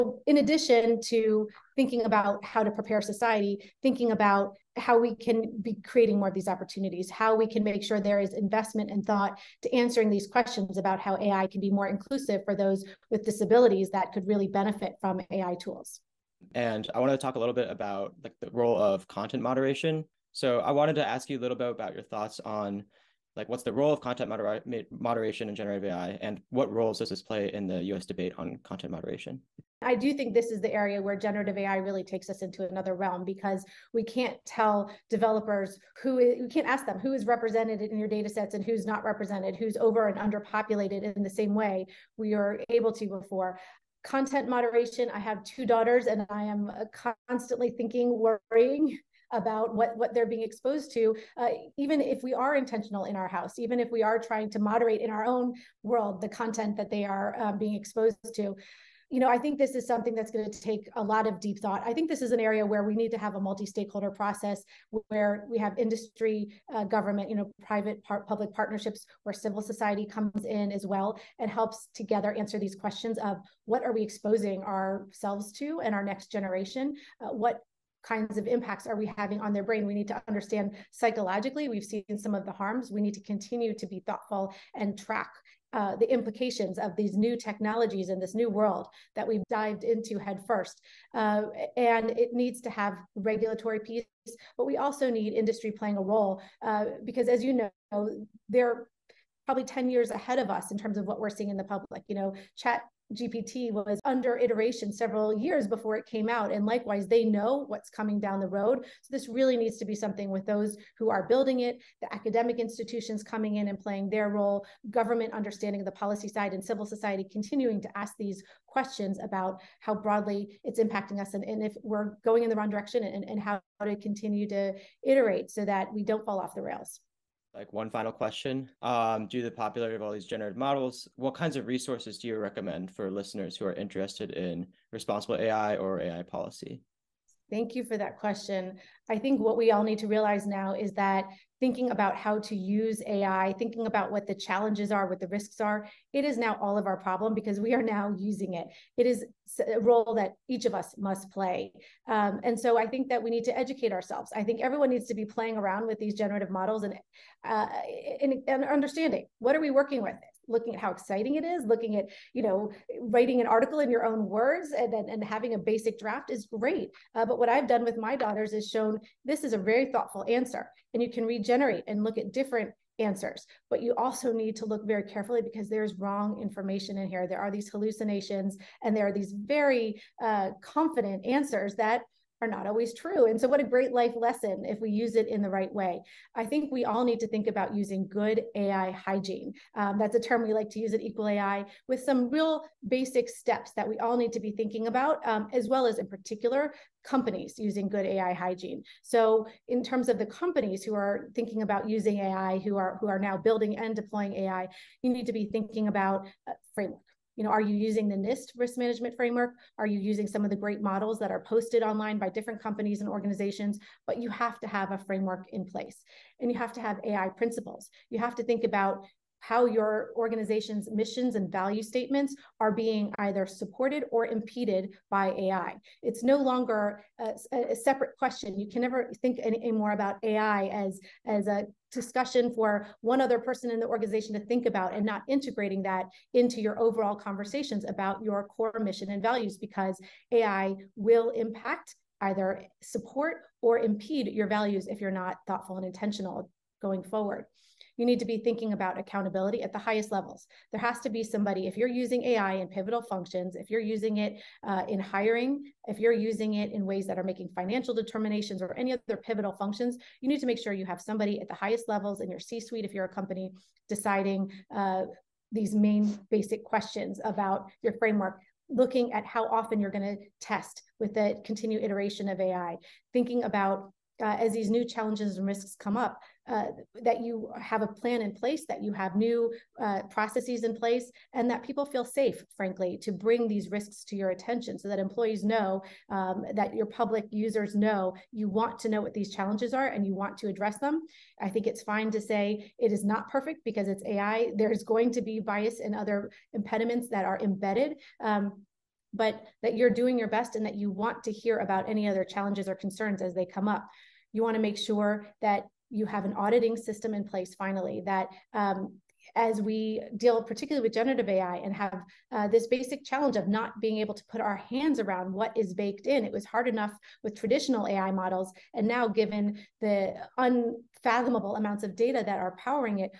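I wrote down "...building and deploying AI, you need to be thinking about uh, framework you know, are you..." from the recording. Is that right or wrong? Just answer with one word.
right.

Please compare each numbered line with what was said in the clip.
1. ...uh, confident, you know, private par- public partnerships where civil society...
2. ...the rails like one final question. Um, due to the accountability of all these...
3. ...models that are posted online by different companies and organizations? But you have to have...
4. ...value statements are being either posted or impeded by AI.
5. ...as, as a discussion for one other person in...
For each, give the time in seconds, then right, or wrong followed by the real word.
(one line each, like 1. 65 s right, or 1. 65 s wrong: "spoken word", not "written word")
1. 66 s wrong: "government", not "confident"
2. 126 s wrong: "popularity", not "accountability"
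3. 210 s right
4. 221 s wrong: "supported", not "posted"
5. 230 s right.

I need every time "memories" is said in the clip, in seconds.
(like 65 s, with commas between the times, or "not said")
not said.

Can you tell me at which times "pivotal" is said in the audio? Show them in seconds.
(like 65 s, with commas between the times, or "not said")
252 s, 259 s.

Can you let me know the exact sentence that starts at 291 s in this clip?
I think it's fine to say it is not perfect because it's AI.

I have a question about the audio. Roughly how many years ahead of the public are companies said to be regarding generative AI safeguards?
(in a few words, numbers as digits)
10 years.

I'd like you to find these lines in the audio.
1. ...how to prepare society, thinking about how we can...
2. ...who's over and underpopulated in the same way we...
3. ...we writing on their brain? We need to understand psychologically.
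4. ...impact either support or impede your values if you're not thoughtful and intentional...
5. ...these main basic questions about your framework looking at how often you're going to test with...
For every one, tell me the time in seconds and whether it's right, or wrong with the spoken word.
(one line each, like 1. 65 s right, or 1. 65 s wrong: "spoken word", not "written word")
1. 2 s right
2. 39 s right
3. 78 s wrong: "having", not "writing"
4. 241 s right
5. 265 s right.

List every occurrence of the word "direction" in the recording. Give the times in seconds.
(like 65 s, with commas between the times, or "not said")
122 s.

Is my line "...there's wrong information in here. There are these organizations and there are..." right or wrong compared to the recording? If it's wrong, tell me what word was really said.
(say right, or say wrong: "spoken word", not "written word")
wrong: "hallucinations", not "organizations".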